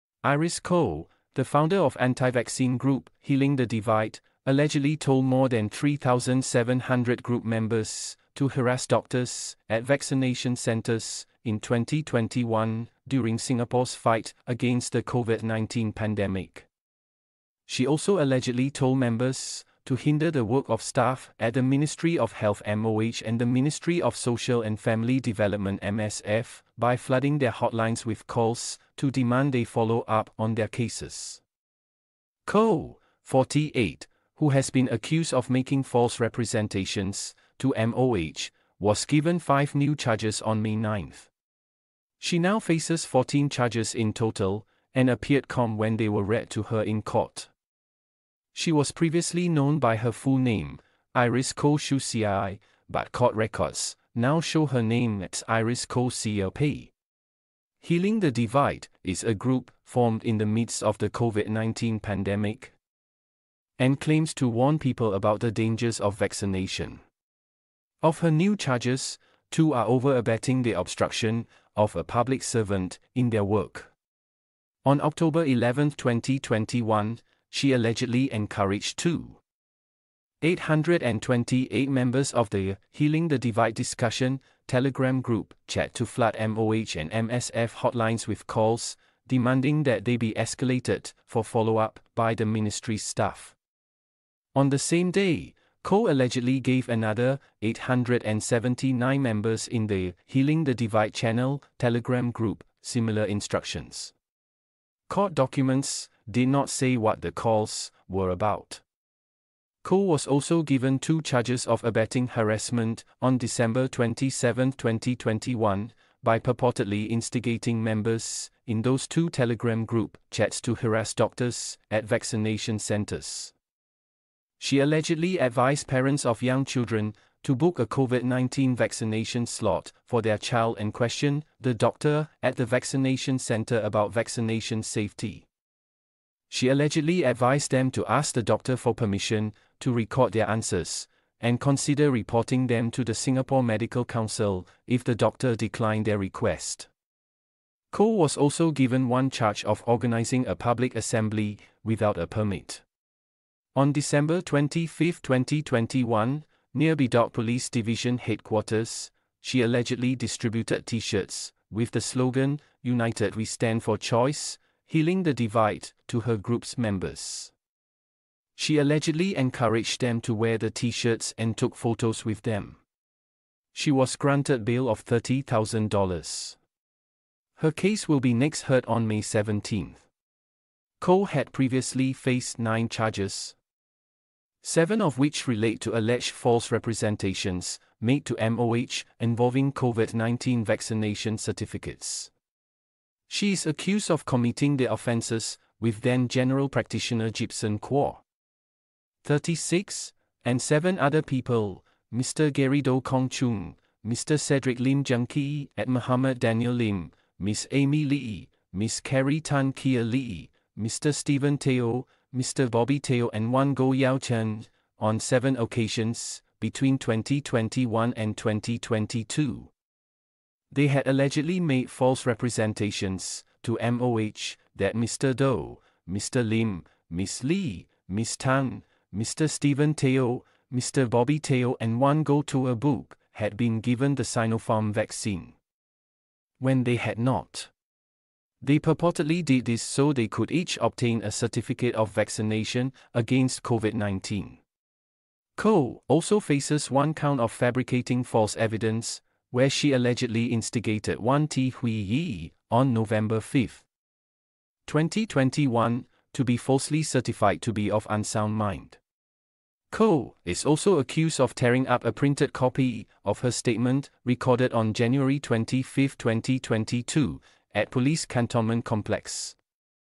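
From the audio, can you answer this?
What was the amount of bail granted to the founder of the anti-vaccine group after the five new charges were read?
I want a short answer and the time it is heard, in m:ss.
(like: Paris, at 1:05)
$30,000, at 2:55.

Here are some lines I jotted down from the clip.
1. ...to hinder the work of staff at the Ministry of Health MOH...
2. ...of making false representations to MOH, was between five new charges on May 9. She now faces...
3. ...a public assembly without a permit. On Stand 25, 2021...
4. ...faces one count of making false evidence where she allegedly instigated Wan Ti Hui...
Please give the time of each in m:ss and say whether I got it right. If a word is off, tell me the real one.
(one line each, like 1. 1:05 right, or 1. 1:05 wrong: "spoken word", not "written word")
1. 0:19 right
2. 0:35 wrong: "given", not "between"
3. 2:30 wrong: "December", not "Stand"
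4. 4:06 wrong: "fabricating", not "making".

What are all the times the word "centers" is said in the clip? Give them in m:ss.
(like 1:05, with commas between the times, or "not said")
0:10, 2:02, 2:13.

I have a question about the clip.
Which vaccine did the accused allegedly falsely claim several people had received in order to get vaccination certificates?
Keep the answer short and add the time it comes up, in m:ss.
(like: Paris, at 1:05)
Sinopharm, at 3:54.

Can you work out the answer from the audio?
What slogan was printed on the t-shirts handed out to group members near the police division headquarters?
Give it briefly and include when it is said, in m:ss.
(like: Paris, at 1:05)
United We Stand for Choice, at 2:42.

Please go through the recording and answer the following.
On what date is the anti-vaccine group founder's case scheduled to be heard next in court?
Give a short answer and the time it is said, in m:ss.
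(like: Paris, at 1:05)
May 17, at 2:59.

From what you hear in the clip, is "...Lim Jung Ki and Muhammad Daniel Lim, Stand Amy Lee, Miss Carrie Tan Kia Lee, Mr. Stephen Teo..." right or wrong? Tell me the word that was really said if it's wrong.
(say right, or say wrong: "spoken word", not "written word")
wrong: "Miss", not "Stand".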